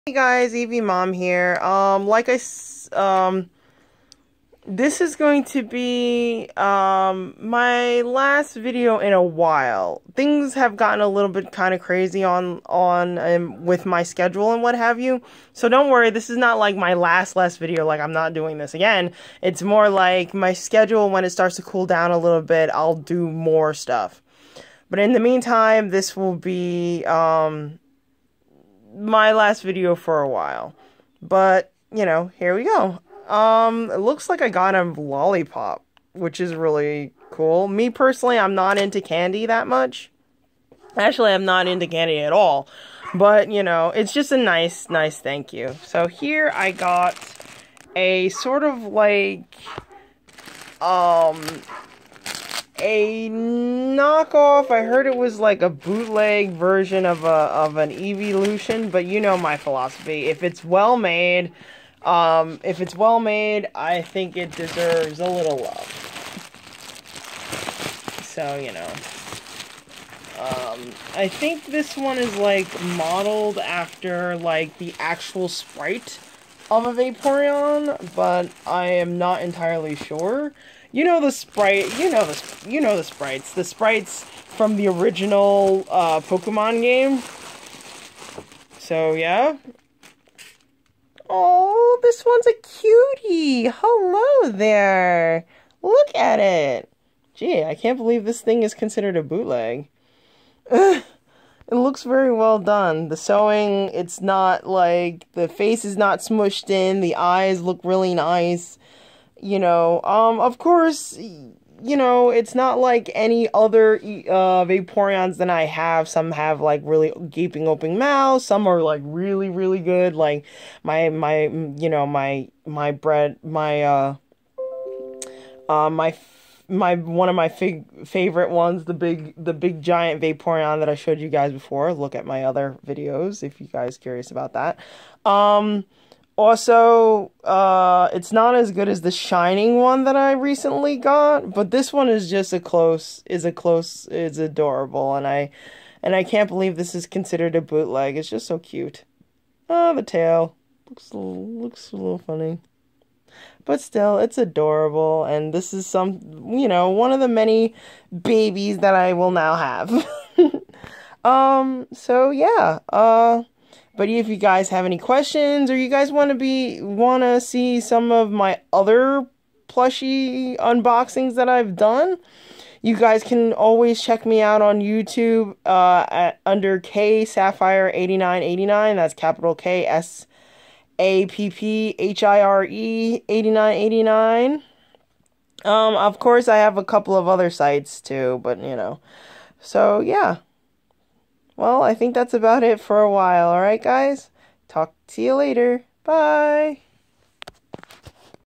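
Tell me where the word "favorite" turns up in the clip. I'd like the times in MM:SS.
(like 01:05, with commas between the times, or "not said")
02:08.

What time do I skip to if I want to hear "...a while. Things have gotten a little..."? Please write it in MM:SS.
00:09.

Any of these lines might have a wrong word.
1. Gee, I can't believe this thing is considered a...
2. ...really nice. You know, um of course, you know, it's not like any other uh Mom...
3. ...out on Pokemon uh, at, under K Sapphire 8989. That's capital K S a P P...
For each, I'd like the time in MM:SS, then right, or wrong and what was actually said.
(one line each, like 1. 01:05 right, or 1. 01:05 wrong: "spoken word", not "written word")
1. 01:37 right
2. 01:47 wrong: "Vaporeons", not "Mom"
3. 02:54 wrong: "YouTube", not "Pokemon".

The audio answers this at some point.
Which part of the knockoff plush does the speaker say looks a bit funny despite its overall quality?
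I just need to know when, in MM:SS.
02:29.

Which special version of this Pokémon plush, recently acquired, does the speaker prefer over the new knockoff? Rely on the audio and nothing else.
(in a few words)
Shining.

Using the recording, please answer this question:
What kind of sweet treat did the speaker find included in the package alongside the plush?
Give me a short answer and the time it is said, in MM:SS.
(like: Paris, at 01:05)
lollipop, at 00:34.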